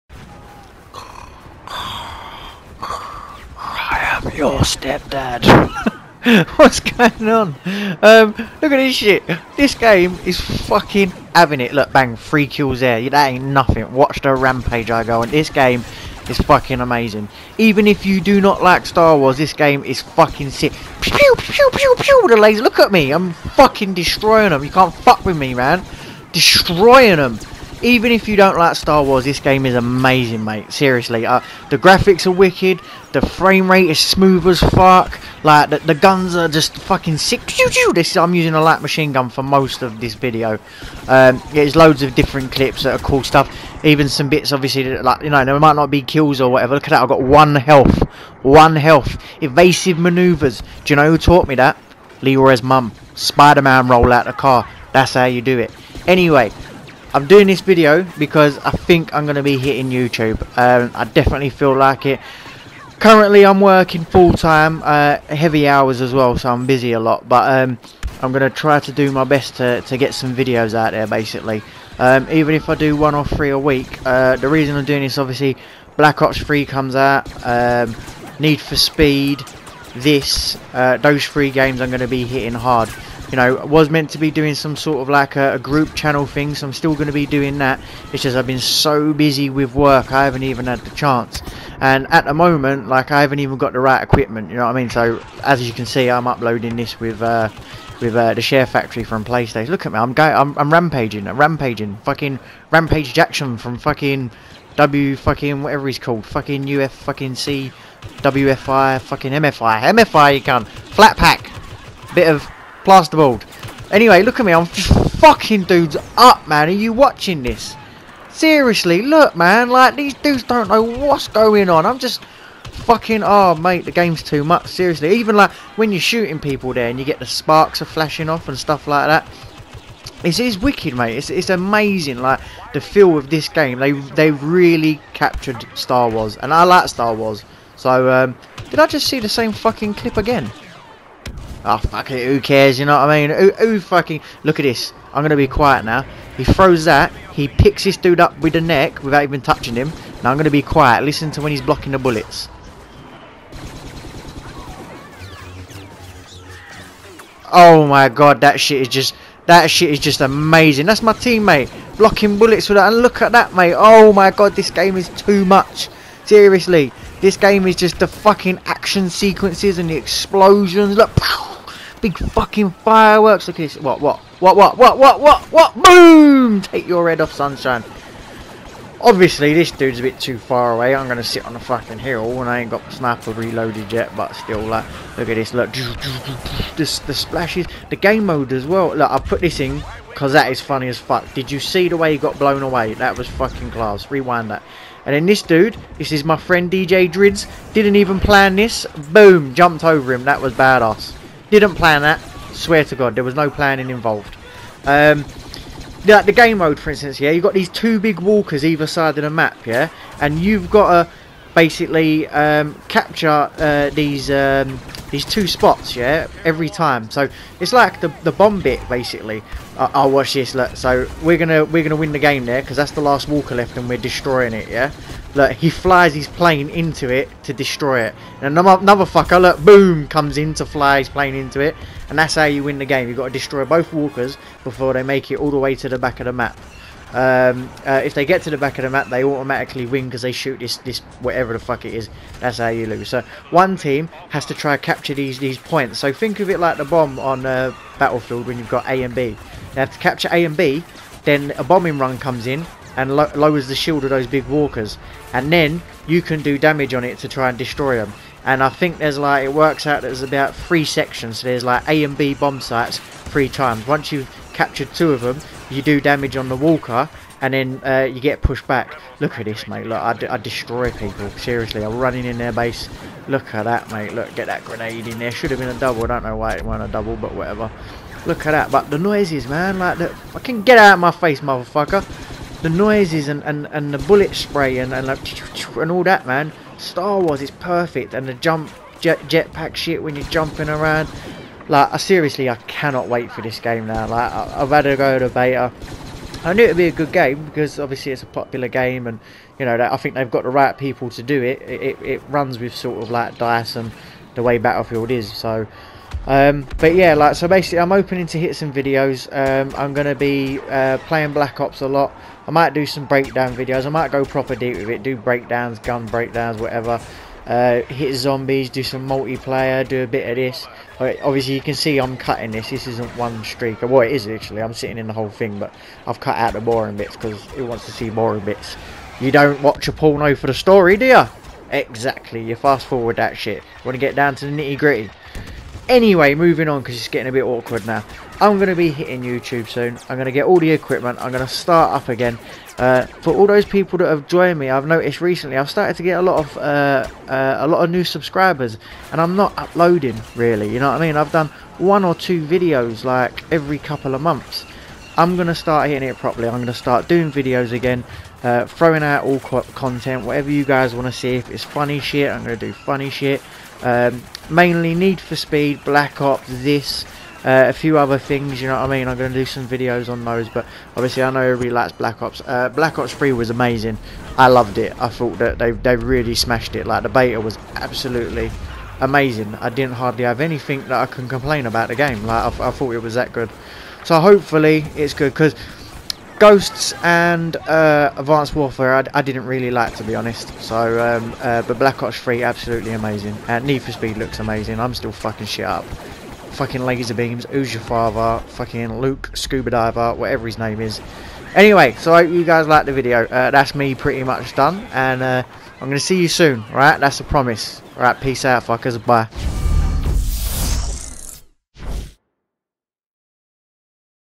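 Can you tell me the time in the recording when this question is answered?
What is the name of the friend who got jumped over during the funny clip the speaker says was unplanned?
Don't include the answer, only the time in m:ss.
3:16.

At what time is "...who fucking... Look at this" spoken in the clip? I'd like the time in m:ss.
2:23.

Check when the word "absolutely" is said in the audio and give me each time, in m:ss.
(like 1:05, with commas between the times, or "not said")
6:17, 6:32.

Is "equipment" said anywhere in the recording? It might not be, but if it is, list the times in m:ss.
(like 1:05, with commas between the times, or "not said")
1:34, 5:40.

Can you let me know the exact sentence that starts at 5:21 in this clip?
obviously, you can see I'm cutting this.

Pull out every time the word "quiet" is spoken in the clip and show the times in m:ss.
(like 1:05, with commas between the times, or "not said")
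2:25, 2:30.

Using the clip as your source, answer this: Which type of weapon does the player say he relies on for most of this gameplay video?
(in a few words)
Light machine gun.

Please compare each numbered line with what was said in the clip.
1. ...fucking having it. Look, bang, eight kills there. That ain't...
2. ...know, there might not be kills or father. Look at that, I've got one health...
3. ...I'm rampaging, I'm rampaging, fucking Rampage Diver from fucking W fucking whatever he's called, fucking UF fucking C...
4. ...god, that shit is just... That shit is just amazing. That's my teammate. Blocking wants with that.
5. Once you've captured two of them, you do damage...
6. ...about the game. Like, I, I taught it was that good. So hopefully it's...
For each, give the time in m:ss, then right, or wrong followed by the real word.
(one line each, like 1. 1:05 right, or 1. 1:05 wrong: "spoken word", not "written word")
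1. 0:10 wrong: "three", not "eight"
2. 0:45 wrong: "whatever", not "father"
3. 1:40 wrong: "Jackson", not "Diver"
4. 2:38 wrong: "bullets", not "wants"
5. 4:23 right
6. 6:21 wrong: "thought", not "taught".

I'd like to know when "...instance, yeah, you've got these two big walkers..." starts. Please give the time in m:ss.
3:26.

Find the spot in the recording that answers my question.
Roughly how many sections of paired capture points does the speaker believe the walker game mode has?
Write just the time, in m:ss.
4:20.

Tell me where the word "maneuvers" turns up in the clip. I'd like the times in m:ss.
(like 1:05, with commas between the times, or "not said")
0:49.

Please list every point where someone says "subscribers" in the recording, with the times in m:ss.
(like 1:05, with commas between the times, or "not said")
5:48.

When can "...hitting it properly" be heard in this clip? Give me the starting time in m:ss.
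5:55.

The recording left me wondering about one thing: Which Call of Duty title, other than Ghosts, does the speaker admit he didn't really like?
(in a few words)
Advanced Warfare.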